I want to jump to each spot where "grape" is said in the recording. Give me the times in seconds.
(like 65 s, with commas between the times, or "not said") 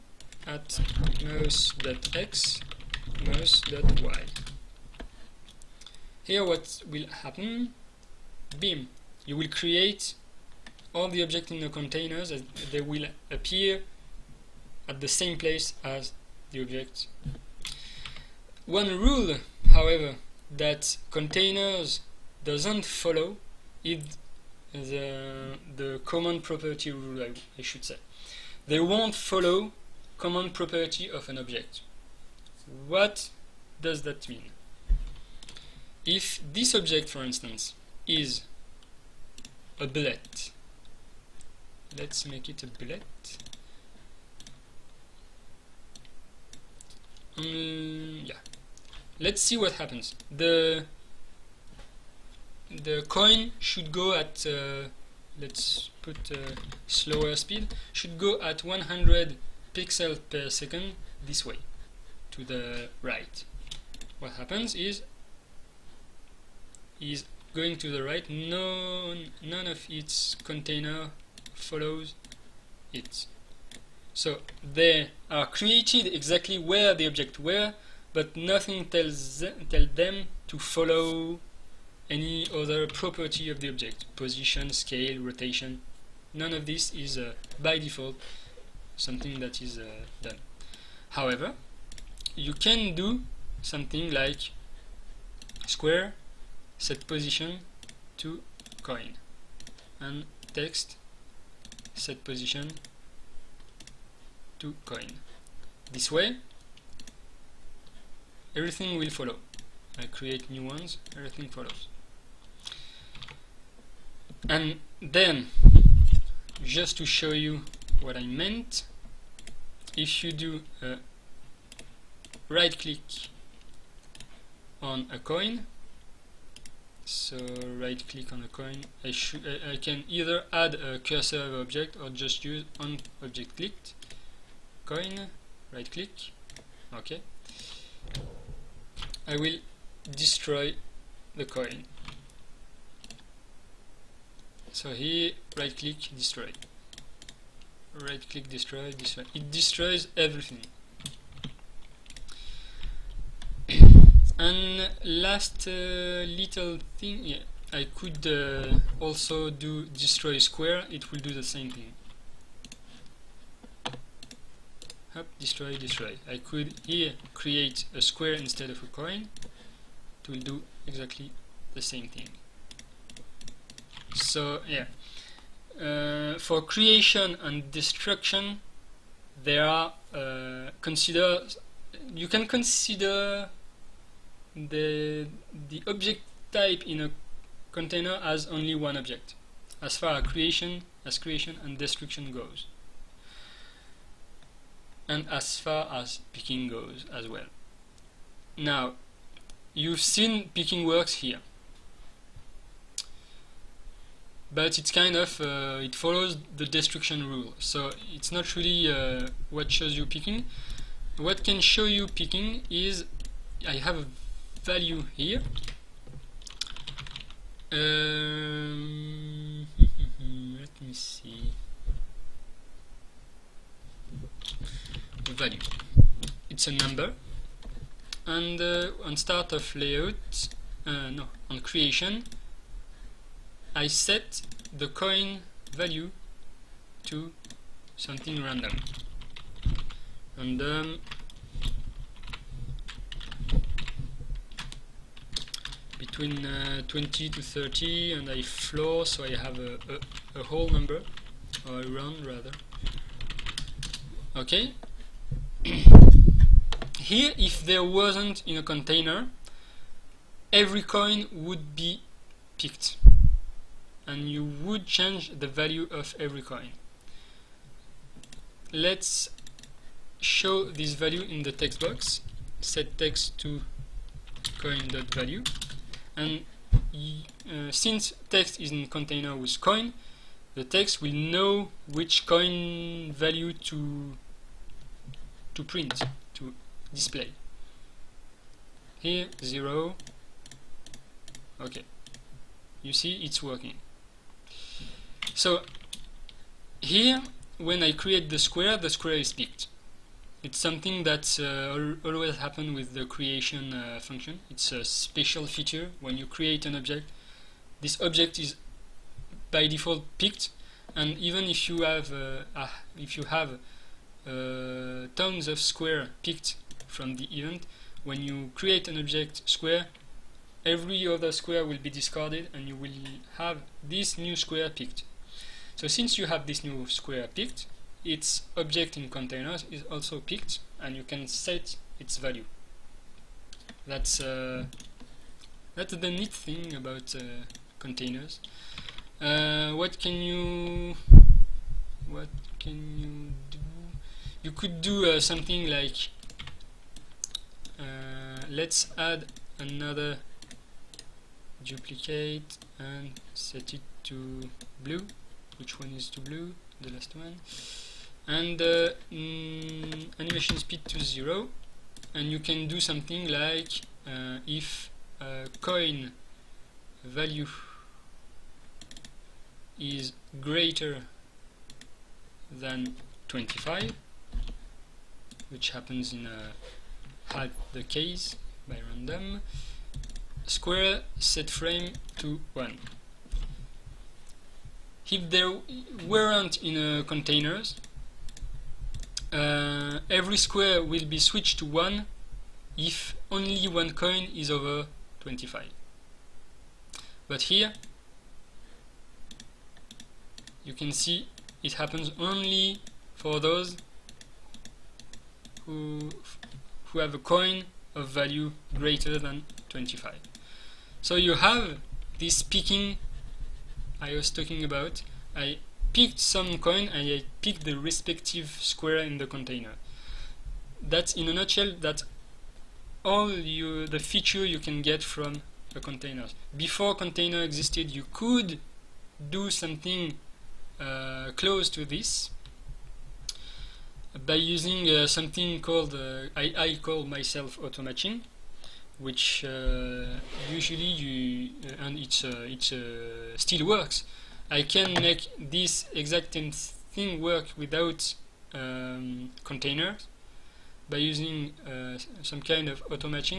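not said.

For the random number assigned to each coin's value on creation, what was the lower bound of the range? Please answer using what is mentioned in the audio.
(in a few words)
20.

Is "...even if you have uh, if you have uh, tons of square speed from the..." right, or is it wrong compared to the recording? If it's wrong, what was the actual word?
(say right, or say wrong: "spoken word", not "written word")
wrong: "picked", not "speed".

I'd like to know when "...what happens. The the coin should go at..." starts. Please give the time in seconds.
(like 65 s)
49 s.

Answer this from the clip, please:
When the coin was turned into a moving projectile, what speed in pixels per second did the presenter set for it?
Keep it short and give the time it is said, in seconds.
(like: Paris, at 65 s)
100, at 58 s.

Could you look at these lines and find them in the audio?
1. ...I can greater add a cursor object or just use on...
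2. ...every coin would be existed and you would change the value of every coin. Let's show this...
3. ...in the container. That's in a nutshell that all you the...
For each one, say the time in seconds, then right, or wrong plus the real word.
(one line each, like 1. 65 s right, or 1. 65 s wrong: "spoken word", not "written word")
1. 129 s wrong: "either", not "greater"
2. 260 s wrong: "picked", not "existed"
3. 418 s right.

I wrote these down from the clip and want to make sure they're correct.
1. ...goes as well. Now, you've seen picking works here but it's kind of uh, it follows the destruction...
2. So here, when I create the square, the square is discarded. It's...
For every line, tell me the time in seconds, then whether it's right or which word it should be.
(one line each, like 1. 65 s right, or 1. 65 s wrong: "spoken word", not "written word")
1. 196 s right
2. 295 s wrong: "picked", not "discarded".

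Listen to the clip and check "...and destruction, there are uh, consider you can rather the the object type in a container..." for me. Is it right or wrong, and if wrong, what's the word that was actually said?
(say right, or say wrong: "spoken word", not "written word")
wrong: "consider", not "rather".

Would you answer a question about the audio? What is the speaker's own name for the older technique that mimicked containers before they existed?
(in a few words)
Automatching.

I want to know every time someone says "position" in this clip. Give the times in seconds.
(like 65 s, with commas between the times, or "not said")
84 s, 97 s, 102 s.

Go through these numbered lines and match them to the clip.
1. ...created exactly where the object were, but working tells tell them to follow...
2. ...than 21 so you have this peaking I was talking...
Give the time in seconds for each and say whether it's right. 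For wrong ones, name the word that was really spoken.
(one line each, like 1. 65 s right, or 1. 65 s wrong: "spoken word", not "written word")
1. 75 s wrong: "nothing", not "working"
2. 409 s wrong: "25", not "21".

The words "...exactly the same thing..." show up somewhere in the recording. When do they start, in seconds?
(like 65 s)
170 s.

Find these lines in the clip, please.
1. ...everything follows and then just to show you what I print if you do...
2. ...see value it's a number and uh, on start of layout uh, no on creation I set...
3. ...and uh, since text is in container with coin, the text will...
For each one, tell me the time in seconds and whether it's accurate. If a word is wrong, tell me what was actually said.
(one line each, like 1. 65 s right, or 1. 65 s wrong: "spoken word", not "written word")
1. 111 s wrong: "meant", not "print"
2. 220 s right
3. 276 s right.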